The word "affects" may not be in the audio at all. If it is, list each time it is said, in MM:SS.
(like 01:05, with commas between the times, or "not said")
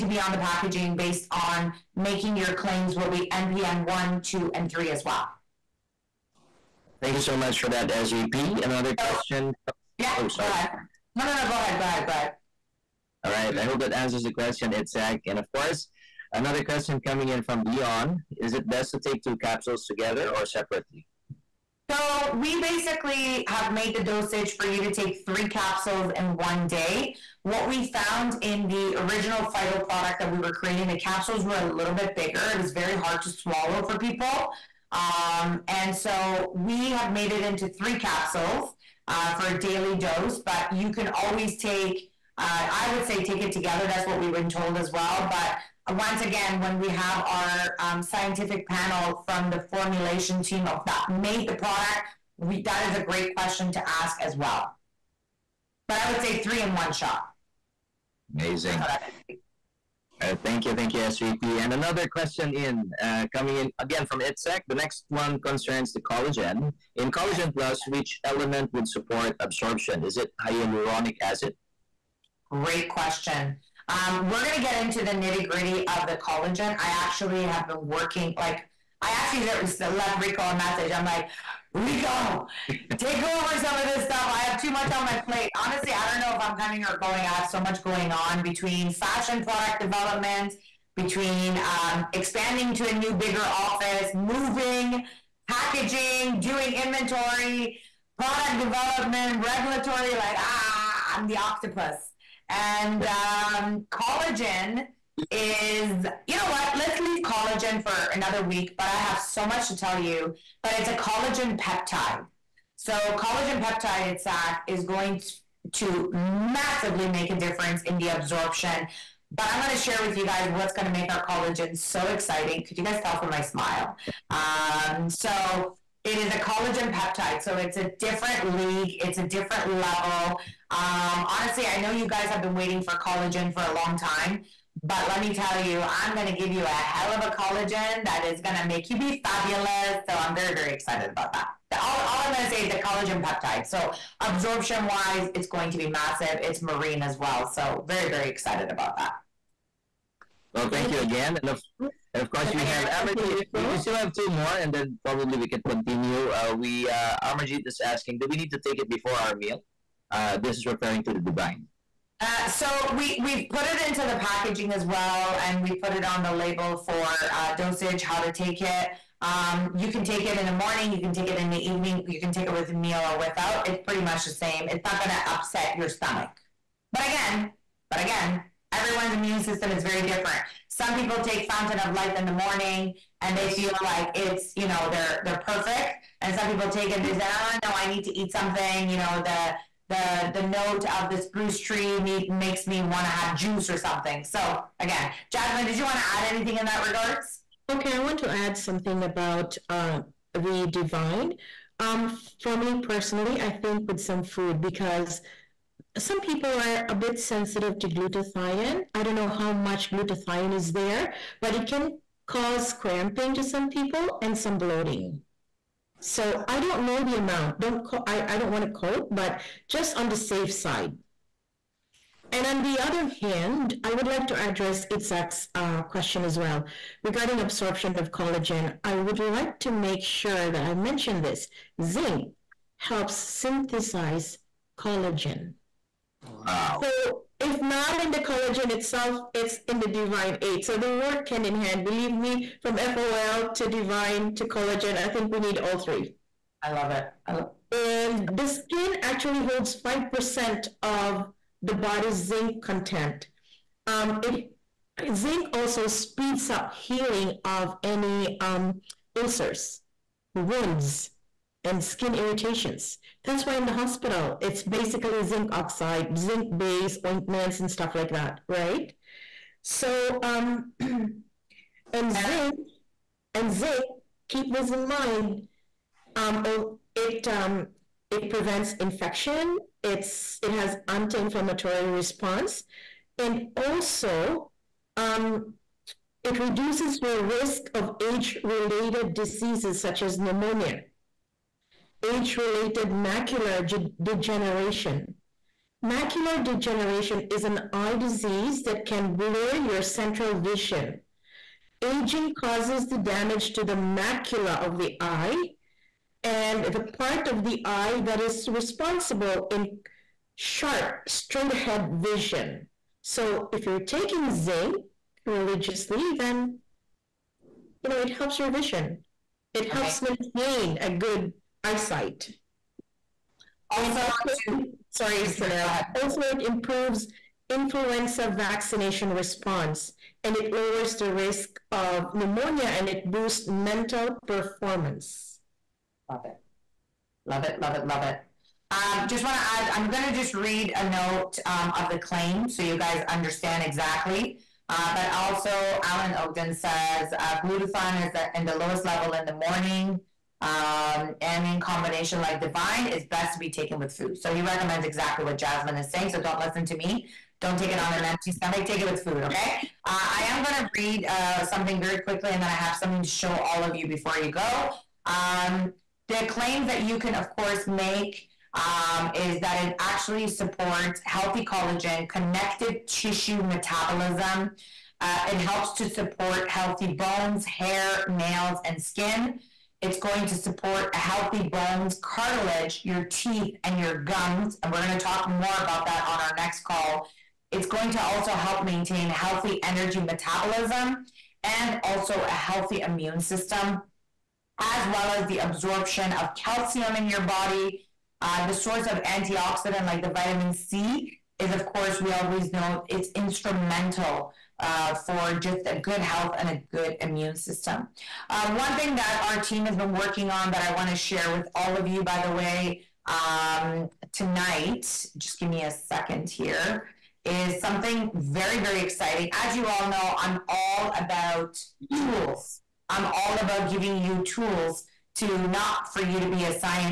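not said.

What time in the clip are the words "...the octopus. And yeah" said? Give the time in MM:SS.
01:41.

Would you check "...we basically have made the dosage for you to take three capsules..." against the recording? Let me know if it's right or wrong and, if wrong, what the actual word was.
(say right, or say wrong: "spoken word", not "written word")
right.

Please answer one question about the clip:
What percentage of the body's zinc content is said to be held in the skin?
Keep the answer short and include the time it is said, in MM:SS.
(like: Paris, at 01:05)
5%, at 04:09.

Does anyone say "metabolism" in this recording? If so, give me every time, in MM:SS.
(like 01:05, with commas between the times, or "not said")
06:13, 06:29.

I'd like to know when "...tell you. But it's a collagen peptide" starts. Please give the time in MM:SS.
01:49.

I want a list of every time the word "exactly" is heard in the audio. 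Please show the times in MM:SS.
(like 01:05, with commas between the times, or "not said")
05:43, 05:54.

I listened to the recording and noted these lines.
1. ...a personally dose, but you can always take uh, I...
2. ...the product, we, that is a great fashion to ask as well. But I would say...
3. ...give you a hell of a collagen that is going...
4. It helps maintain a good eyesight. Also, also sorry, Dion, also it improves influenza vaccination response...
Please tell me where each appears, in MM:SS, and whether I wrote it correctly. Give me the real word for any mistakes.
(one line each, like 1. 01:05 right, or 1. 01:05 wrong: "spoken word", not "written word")
1. 00:39 wrong: "daily", not "personally"
2. 00:51 wrong: "question", not "fashion"
3. 02:16 right
4. 05:19 wrong: "Sanaz", not "Dion".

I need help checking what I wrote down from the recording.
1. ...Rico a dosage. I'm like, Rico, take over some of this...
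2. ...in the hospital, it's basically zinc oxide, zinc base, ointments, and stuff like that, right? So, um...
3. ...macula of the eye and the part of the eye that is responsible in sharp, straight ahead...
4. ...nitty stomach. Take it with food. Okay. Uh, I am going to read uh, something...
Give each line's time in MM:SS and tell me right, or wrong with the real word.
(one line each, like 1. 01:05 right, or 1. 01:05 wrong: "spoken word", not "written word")
1. 01:20 wrong: "message", not "dosage"
2. 04:23 right
3. 05:03 right
4. 05:58 wrong: "empty", not "nitty".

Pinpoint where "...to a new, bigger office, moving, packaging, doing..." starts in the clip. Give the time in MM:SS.
01:32.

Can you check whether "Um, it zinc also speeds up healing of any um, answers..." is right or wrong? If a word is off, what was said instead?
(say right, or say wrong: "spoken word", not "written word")
wrong: "ulcers", not "answers".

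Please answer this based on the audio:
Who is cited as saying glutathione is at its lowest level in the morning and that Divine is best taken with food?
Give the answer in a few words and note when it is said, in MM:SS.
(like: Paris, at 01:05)
Alan Ogden, at 05:45.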